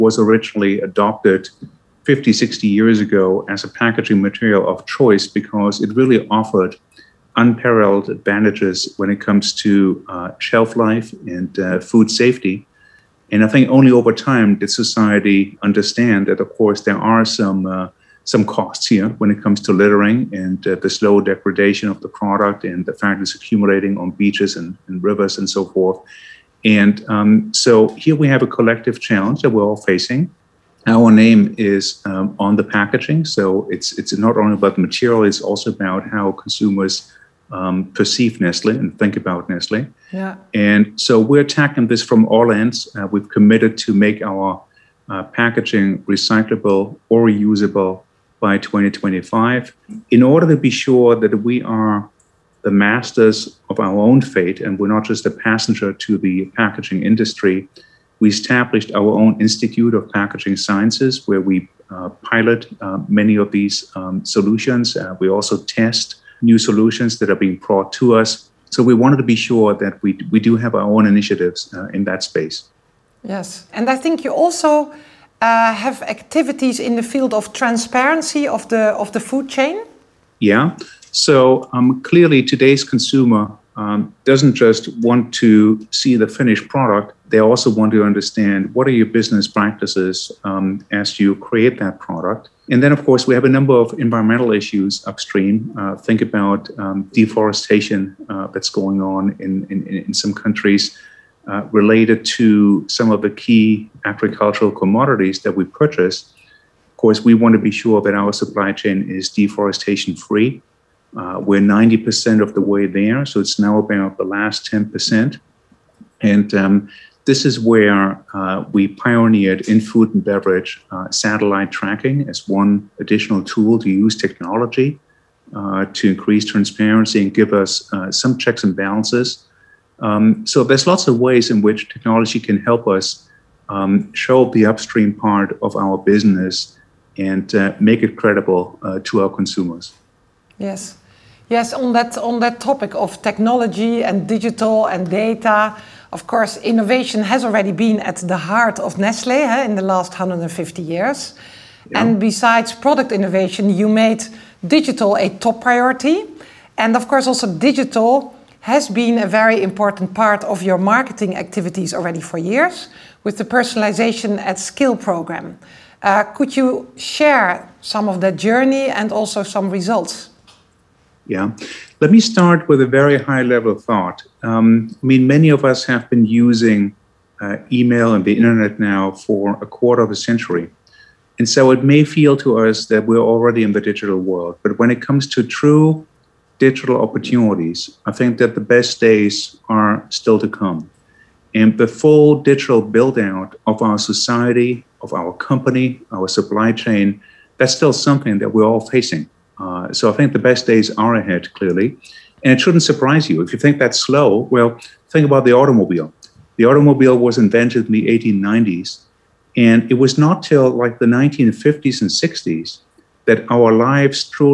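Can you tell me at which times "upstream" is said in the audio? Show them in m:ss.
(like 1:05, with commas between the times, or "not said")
1:35, 2:14.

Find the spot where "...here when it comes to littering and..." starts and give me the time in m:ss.
0:18.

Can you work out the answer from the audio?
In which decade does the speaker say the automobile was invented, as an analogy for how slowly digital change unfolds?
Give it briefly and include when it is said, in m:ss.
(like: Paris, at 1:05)
1890s, at 3:28.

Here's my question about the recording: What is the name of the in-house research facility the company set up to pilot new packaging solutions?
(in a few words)
Institute of Packaging Sciences.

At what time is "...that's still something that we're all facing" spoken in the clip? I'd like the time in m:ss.
3:17.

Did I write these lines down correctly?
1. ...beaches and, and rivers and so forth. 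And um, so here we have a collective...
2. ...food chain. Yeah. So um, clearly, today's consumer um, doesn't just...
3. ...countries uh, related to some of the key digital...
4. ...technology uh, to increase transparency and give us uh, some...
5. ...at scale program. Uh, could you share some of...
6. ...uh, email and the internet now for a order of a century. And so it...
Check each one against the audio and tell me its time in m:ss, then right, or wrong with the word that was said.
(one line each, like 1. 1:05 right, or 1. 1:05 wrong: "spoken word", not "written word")
1. 0:24 right
2. 1:19 right
3. 1:40 wrong: "agricultural", not "digital"
4. 2:04 right
5. 2:44 right
6. 2:57 wrong: "quarter", not "order".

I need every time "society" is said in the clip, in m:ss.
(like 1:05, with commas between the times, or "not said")
0:14, 3:13.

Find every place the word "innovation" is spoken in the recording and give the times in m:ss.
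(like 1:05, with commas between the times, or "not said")
2:26, 2:33.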